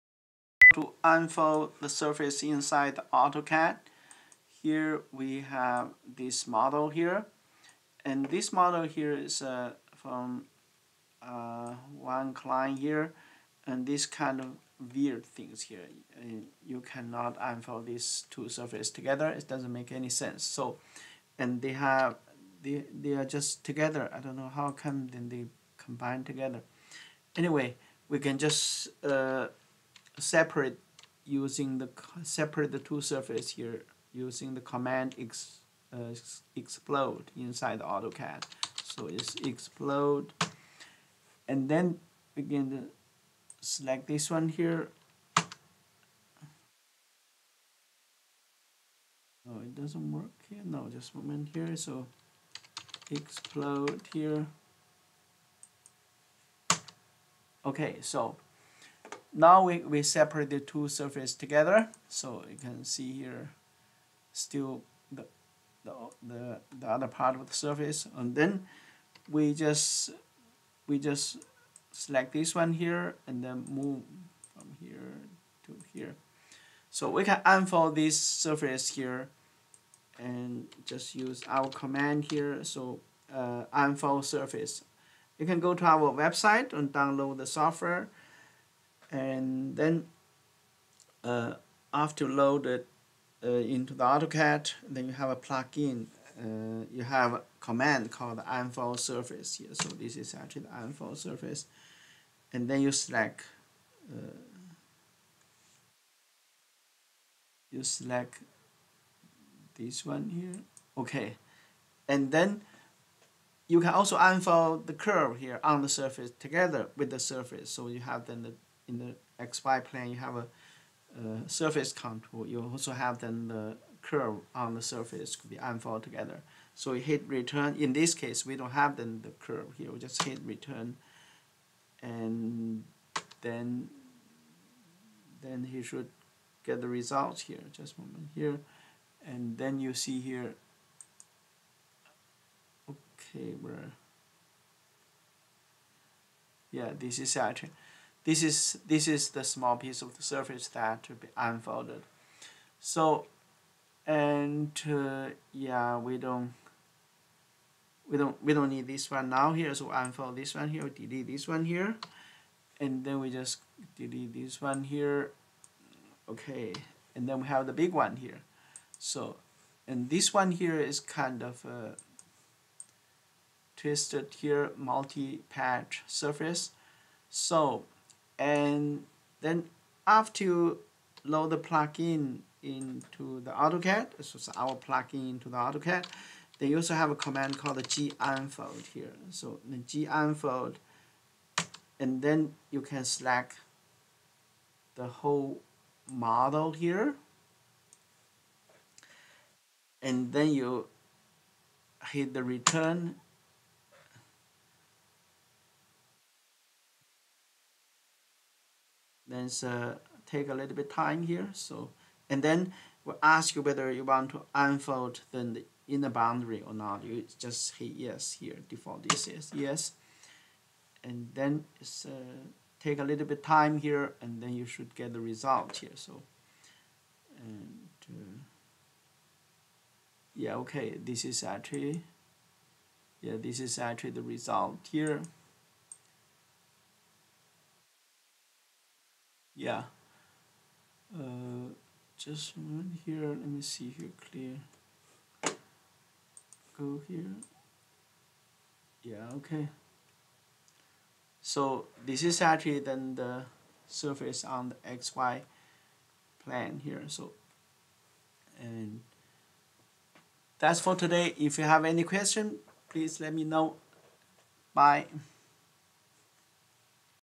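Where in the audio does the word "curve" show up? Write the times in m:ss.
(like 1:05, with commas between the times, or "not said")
1:54, 2:04, 2:09.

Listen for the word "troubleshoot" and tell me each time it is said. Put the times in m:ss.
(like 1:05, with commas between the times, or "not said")
not said.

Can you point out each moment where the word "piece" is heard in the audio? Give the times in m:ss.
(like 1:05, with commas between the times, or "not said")
2:29.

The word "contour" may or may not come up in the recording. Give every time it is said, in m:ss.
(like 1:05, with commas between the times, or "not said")
2:01.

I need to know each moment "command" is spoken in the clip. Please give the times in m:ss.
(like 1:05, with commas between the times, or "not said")
0:34, 1:21, 1:37, 3:07.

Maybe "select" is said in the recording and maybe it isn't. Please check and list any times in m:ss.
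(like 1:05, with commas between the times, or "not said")
0:43, 1:11, 1:42, 1:47, 3:13.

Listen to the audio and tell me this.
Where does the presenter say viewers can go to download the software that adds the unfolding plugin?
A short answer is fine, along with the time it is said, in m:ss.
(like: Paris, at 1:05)
our website, at 1:25.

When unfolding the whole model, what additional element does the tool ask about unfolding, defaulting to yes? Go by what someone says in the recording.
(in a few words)
inner boundary.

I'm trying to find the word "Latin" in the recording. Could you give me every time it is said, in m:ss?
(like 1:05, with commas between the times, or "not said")
not said.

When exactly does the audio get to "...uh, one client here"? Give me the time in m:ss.
0:11.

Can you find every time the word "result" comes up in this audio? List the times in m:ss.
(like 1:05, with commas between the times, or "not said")
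2:16, 3:45, 3:54.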